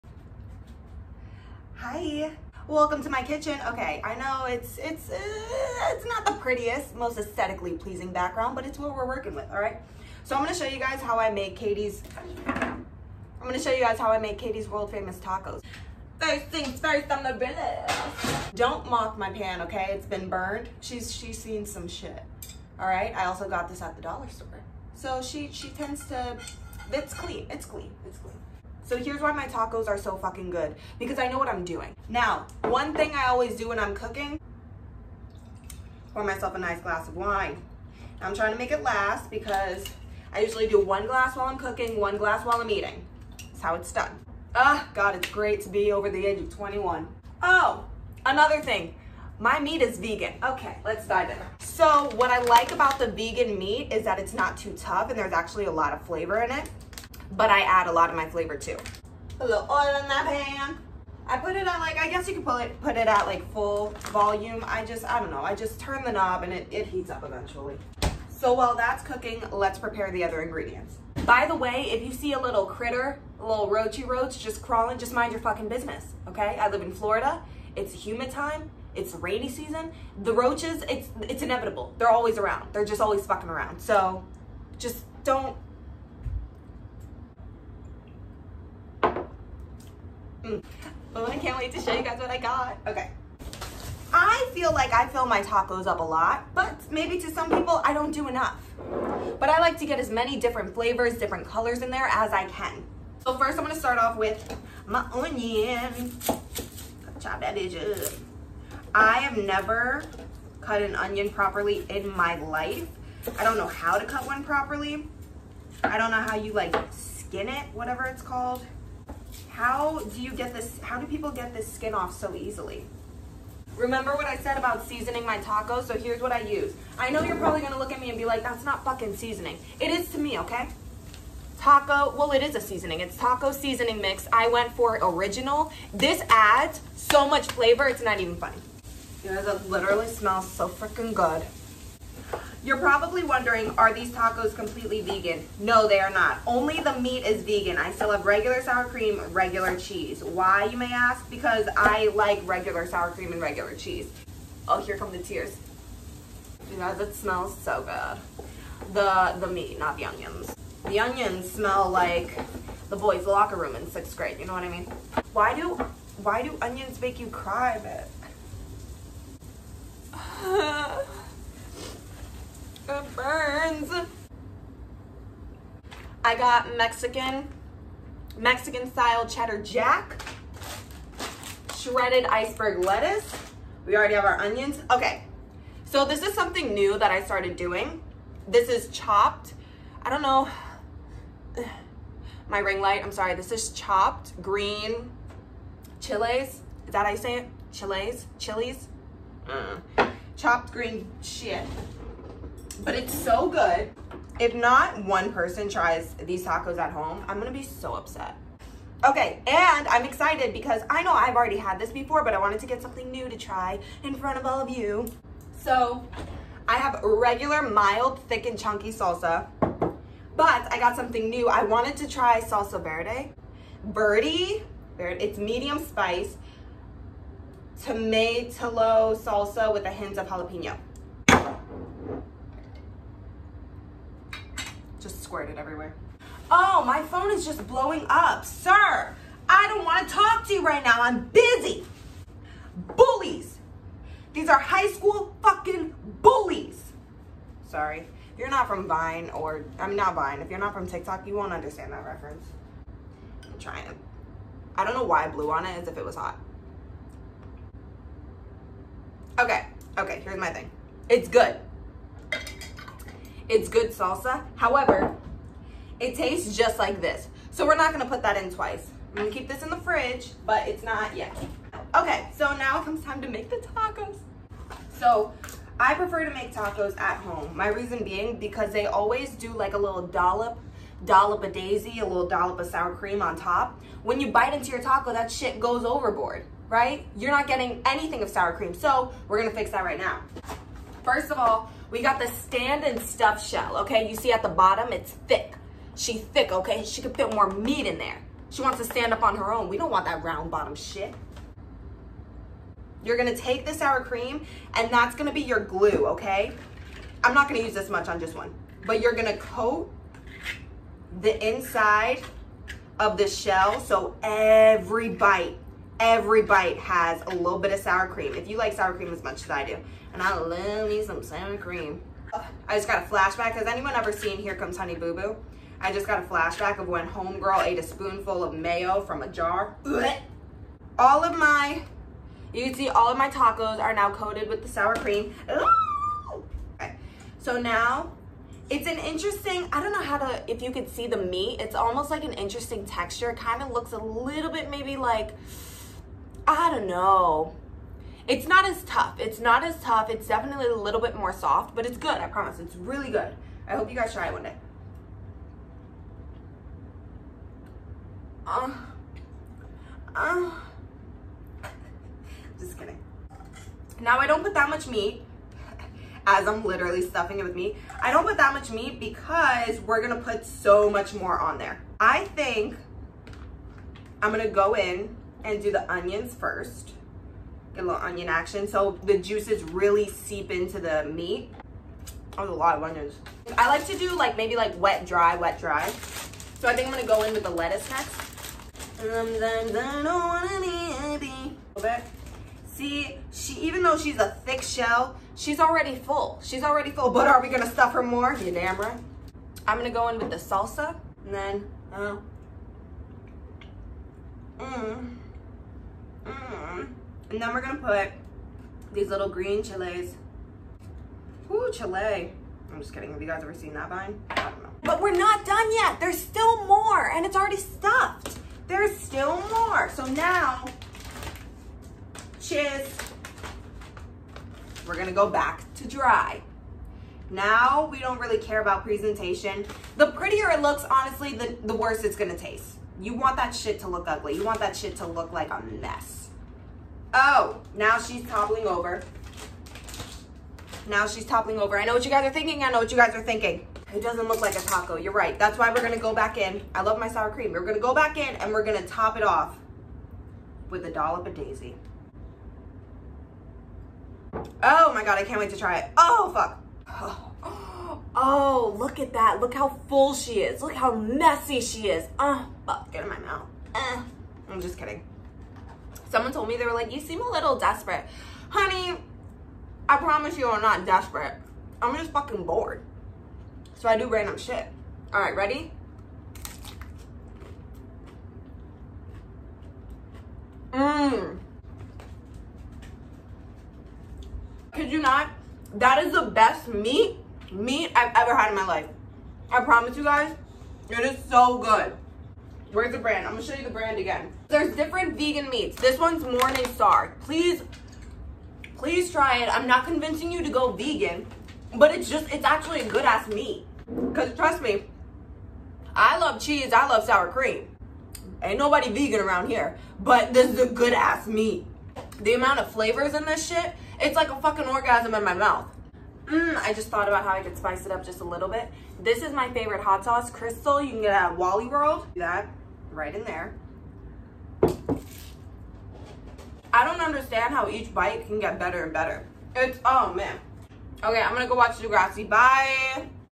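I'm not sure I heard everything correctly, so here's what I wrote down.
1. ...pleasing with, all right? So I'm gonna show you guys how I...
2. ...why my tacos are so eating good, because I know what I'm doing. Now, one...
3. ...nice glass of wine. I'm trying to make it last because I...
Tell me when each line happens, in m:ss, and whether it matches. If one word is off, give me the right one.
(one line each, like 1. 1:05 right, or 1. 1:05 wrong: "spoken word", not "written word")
1. 0:09 wrong: "working", not "pleasing"
2. 0:29 wrong: "fucking", not "eating"
3. 0:36 right.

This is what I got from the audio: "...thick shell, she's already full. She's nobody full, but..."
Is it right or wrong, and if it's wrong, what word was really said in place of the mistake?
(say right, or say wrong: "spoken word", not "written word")
wrong: "already", not "nobody".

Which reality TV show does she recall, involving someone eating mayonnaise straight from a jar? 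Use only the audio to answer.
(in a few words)
Here Comes Honey Boo Boo.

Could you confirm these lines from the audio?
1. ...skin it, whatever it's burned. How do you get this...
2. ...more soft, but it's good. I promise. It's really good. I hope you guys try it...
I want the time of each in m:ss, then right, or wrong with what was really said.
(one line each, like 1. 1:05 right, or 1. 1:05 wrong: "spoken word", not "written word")
1. 1:56 wrong: "called", not "burned"
2. 5:51 right.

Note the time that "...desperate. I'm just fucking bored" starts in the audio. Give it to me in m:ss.
7:50.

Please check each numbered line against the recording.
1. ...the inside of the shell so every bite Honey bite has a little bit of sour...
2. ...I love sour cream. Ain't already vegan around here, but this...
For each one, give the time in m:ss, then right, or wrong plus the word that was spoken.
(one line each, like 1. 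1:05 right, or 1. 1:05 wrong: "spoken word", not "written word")
1. 5:11 wrong: "Every", not "Honey"
2. 8:26 wrong: "nobody", not "already".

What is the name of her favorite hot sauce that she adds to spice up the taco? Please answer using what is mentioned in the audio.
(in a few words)
Crystal.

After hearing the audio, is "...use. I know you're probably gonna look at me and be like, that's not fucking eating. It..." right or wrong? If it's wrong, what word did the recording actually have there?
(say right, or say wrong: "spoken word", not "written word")
wrong: "seasoning", not "eating".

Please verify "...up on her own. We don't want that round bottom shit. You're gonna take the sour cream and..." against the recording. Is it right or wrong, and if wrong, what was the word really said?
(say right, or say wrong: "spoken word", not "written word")
right.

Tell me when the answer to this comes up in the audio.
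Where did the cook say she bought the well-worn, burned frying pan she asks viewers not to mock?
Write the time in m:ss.
0:23.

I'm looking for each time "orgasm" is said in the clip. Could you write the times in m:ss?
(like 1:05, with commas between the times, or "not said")
8:34.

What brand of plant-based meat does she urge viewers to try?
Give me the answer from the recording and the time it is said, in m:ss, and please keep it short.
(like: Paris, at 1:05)
Morningstar, at 8:16.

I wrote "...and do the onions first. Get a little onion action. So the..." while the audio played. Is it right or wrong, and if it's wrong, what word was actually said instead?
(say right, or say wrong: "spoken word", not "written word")
right.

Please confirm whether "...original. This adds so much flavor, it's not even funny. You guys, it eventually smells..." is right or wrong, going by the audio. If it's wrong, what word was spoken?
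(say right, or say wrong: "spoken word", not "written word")
wrong: "literally", not "eventually".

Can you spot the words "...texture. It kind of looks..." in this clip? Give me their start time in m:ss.
5:42.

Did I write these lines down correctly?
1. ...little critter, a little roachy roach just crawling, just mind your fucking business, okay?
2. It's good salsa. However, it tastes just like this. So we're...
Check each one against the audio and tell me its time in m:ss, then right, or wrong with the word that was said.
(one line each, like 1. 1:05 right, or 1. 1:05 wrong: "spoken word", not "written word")
1. 1:12 right
2. 4:23 right.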